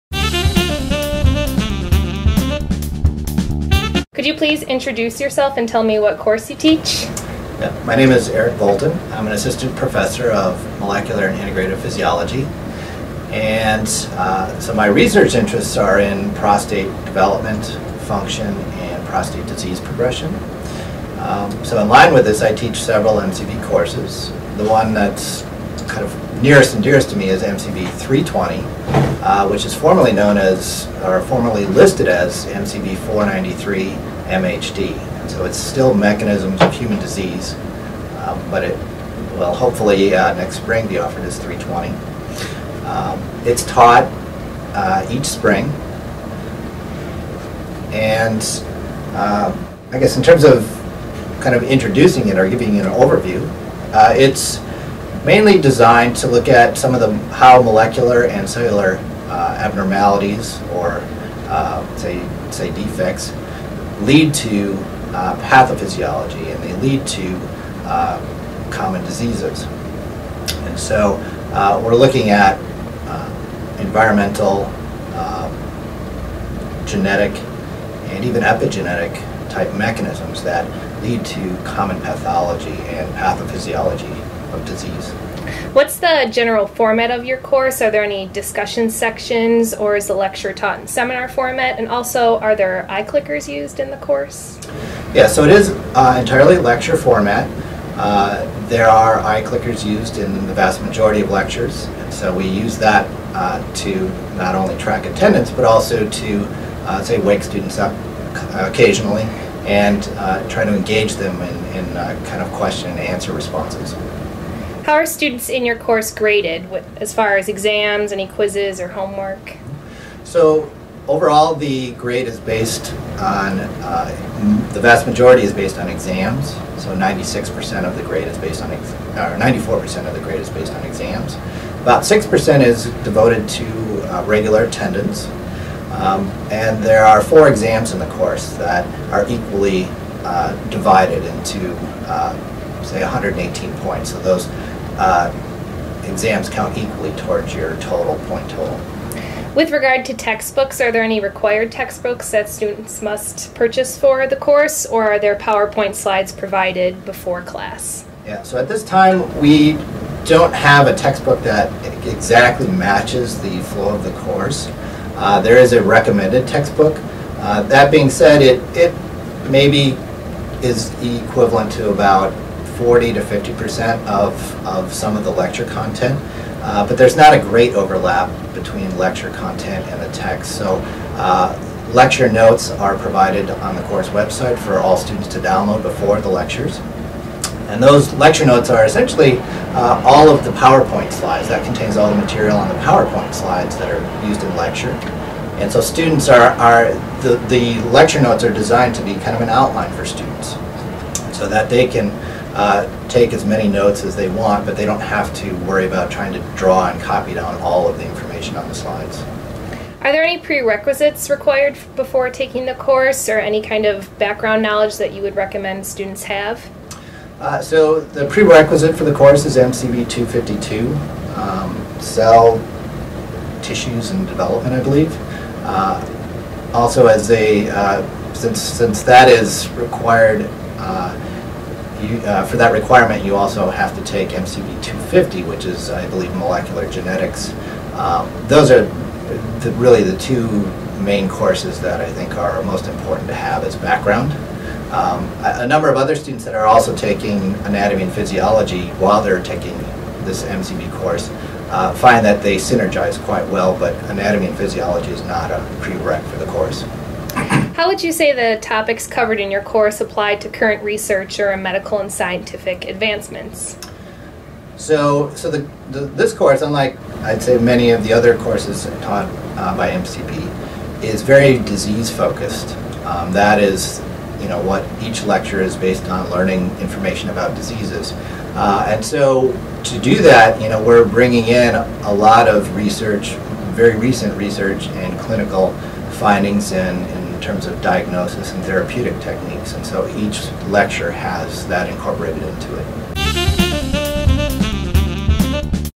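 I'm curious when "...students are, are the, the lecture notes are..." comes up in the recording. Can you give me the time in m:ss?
3:15.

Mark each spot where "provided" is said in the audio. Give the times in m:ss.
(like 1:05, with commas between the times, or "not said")
2:36, 3:02.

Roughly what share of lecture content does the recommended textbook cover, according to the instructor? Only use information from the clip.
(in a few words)
40 to 50 percent.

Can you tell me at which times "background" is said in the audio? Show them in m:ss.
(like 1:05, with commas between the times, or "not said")
3:34, 4:03.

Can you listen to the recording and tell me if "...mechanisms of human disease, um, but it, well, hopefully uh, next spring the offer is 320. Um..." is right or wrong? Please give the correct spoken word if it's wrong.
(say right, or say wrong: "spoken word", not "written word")
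right.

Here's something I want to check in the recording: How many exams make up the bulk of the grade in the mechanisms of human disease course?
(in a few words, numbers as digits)
4.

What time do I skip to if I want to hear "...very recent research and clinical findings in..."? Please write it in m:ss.
4:43.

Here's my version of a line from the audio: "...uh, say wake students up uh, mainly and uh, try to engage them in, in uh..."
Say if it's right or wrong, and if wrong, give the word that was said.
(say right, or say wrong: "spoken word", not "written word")
wrong: "occasionally", not "mainly".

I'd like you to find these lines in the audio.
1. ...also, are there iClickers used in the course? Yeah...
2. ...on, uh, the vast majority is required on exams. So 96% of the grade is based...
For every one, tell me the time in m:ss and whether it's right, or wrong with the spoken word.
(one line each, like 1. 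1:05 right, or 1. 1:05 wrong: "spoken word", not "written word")
1. 1:31 right
2. 2:03 wrong: "based", not "required".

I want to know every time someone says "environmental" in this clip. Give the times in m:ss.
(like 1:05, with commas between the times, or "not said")
1:13.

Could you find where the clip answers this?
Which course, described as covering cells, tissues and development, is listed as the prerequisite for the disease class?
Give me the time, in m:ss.
3:39.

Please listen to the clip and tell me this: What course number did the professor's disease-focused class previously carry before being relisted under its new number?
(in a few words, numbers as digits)
MCB 493.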